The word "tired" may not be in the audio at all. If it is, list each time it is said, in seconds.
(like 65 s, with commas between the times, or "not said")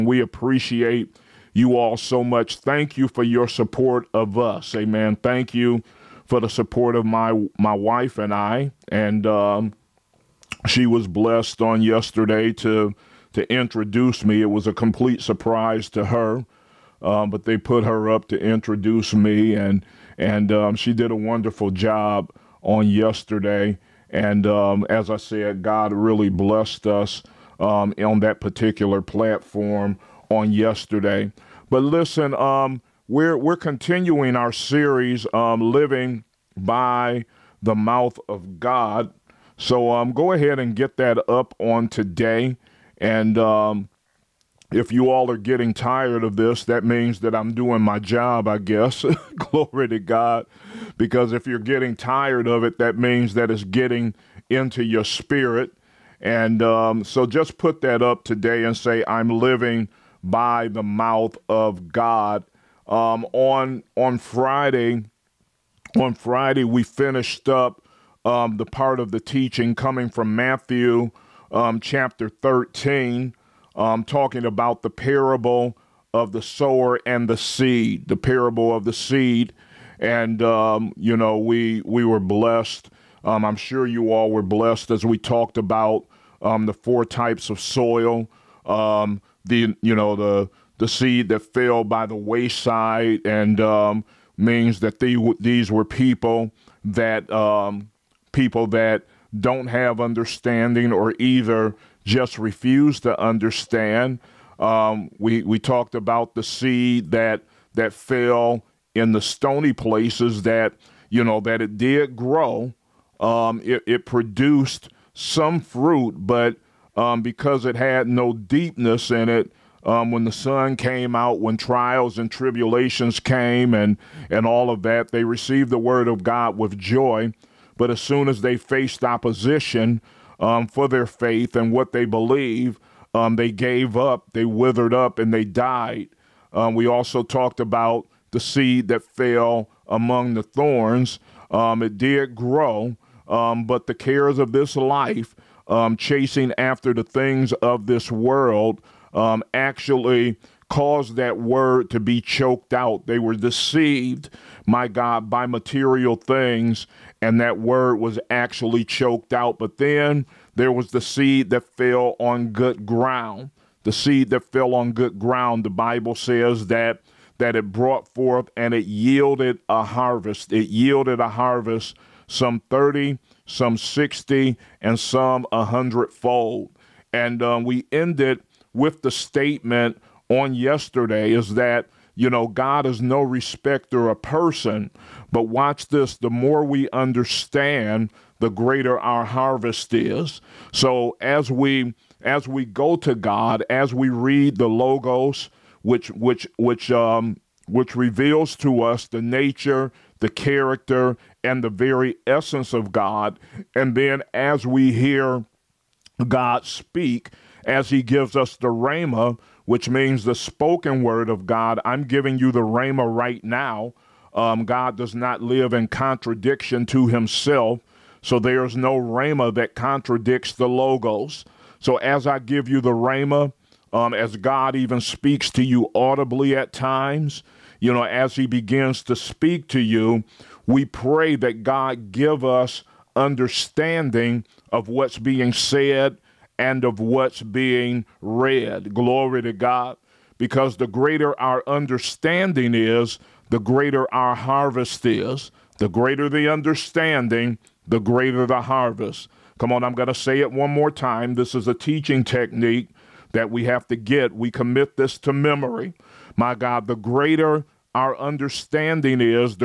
45 s, 51 s.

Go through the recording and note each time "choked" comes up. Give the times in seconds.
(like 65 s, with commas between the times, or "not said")
152 s, 158 s.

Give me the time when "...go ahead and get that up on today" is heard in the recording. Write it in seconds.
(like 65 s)
40 s.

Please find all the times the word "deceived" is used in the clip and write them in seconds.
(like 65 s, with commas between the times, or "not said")
153 s.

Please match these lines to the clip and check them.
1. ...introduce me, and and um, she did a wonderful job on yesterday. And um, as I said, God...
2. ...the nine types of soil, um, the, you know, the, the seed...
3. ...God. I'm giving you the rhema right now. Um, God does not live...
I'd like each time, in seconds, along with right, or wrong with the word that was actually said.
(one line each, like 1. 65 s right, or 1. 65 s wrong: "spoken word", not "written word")
1. 18 s right
2. 86 s wrong: "four", not "nine"
3. 211 s right.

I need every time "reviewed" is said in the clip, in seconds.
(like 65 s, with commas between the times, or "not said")
not said.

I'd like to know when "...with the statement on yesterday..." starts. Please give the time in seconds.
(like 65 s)
178 s.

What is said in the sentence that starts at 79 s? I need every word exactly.
And, um, you know, we, we were blessed.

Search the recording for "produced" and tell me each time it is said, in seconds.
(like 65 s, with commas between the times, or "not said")
114 s.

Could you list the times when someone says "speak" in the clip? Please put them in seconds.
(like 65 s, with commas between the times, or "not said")
206 s, 224 s, 229 s.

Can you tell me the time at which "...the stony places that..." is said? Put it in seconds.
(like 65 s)
109 s.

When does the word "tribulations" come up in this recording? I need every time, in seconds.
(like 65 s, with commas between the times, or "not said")
122 s.